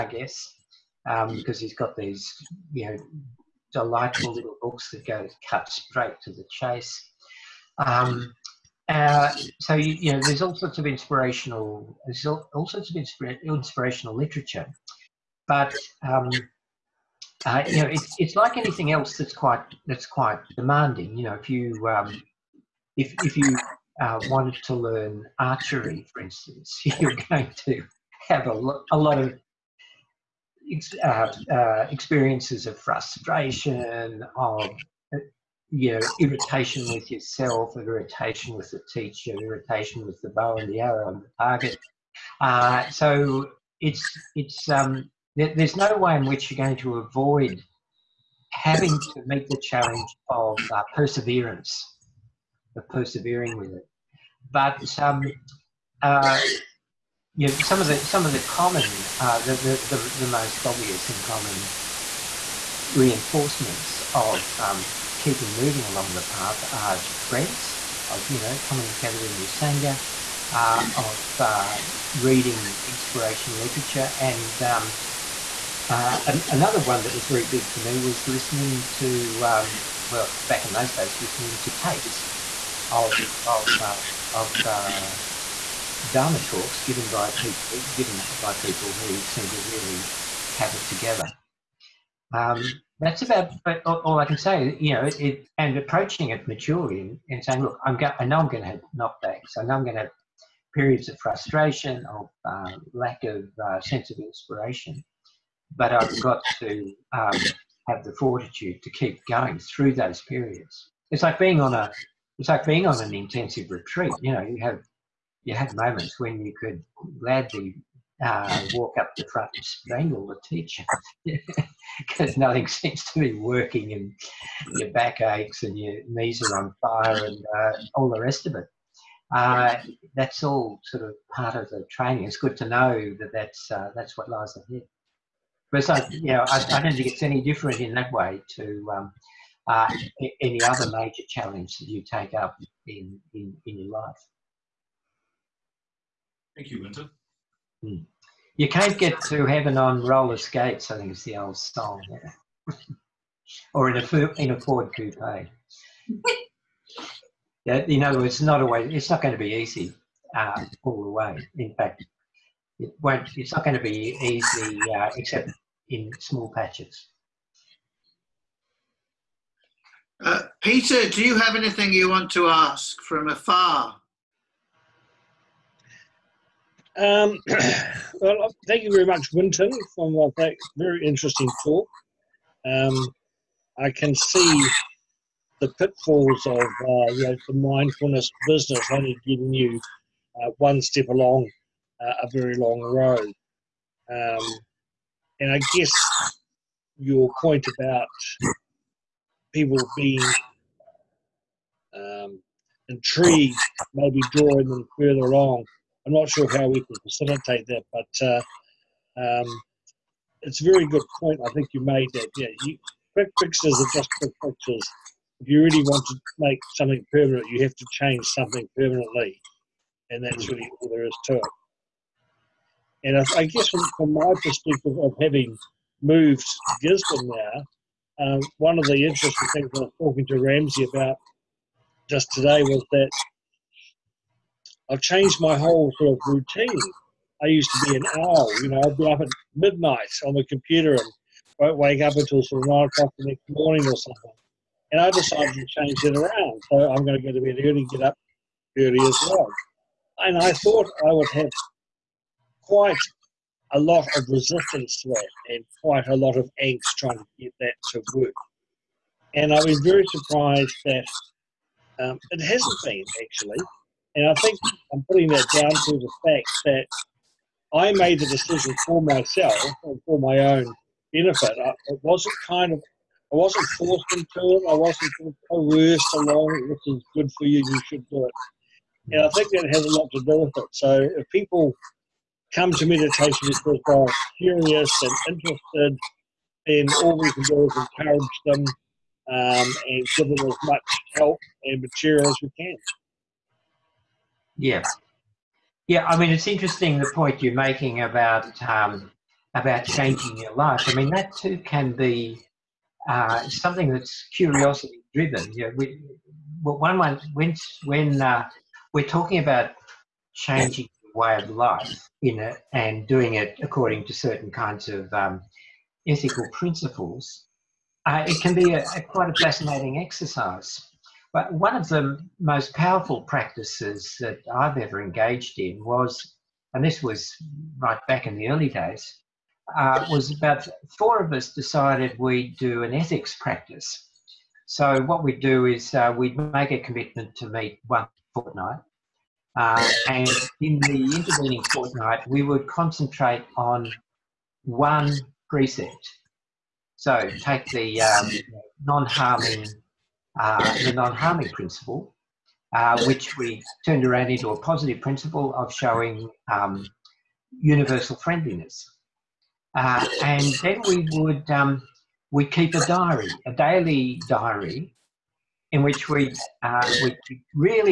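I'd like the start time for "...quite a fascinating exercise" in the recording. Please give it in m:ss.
5:19.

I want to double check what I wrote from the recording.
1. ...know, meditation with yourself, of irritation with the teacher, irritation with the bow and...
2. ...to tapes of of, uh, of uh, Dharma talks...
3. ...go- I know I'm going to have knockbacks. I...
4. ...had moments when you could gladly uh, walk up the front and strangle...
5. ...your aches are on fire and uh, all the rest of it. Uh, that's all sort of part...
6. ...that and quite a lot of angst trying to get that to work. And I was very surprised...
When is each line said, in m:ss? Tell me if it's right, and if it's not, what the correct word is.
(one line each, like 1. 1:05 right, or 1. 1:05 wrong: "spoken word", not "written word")
1. 0:35 wrong: "irritation", not "meditation"
2. 1:21 right
3. 1:37 right
4. 1:55 right
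5. 2:05 wrong: "knees", not "aches"
6. 4:15 right.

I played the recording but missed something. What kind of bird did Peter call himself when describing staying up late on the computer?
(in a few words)
an owl.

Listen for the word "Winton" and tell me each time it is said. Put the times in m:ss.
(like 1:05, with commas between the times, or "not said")
2:26, 2:59.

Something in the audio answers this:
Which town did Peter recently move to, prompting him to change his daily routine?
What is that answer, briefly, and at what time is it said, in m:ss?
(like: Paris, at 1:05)
Gisborne, at 3:46.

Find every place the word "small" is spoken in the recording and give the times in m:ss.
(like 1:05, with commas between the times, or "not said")
2:46.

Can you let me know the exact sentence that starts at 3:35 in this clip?
If you really want to make something permanent, you have to change something permanently, and that's really all there is to it.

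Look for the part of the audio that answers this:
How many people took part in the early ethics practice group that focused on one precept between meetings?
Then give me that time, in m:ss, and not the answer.
5:30.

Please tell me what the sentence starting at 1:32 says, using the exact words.
Um, that's about but all, all I can say.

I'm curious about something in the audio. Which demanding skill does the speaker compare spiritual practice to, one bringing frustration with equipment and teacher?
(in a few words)
archery.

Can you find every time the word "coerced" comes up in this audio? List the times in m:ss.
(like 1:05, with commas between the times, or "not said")
4:35.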